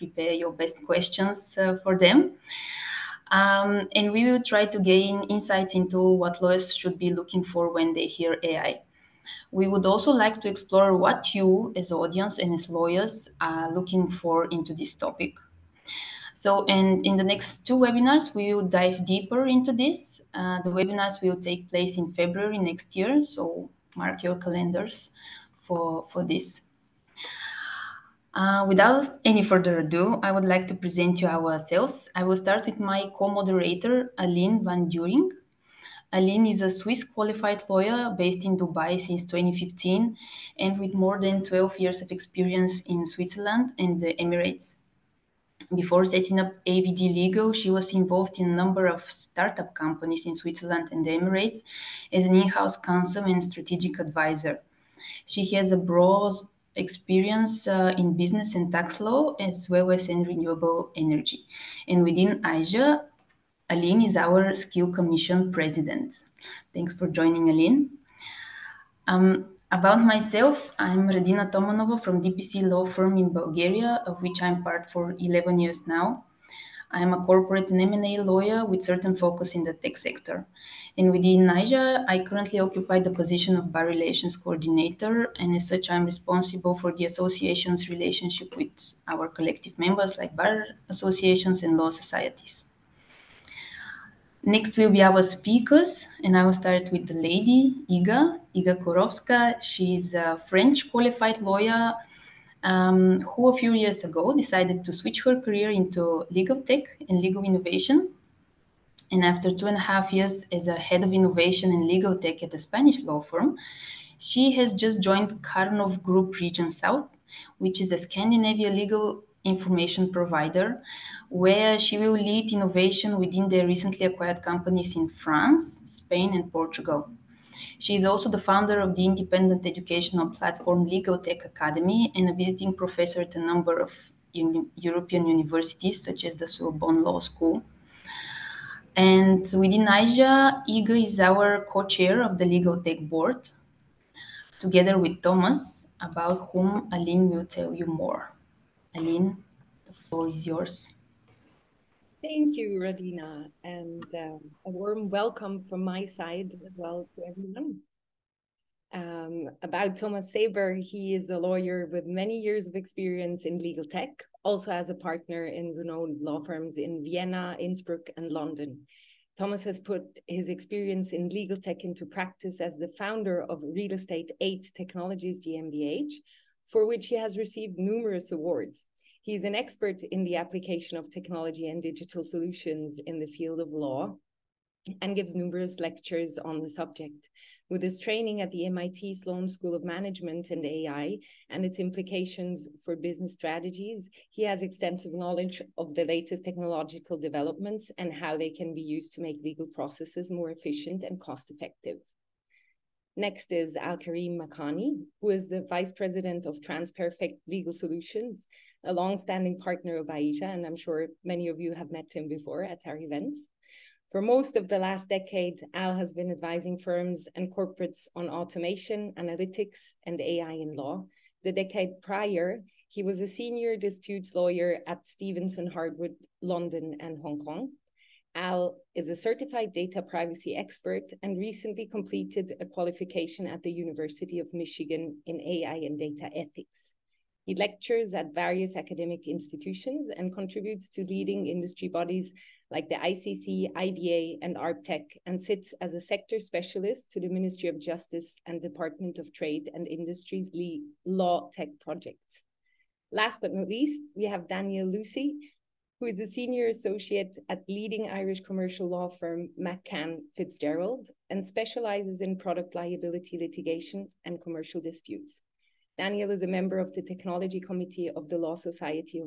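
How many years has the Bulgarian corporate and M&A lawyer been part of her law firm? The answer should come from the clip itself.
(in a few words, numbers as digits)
11.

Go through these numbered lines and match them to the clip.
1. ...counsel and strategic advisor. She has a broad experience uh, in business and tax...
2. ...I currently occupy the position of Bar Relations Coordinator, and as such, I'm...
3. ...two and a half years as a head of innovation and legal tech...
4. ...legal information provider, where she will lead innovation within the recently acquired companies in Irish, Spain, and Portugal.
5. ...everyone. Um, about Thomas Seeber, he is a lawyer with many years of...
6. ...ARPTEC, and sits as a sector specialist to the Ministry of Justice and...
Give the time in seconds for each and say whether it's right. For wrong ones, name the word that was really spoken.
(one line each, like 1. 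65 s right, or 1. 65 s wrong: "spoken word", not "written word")
1. 52 s right
2. 82 s right
3. 109 s right
4. 118 s wrong: "France", not "Irish"
5. 157 s right
6. 244 s right.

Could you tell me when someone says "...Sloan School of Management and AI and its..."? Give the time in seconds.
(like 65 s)
189 s.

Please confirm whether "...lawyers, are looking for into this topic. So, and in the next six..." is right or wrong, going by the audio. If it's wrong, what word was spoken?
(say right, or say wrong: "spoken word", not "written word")
wrong: "two", not "six".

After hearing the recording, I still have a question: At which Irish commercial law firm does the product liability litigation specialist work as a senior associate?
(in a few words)
McCann FitzGerald.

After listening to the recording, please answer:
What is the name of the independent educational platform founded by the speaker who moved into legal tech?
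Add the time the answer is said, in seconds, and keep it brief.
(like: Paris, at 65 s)
Legal Tech Academy, at 130 s.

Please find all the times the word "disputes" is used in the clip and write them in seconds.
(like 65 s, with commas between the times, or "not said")
223 s, 264 s.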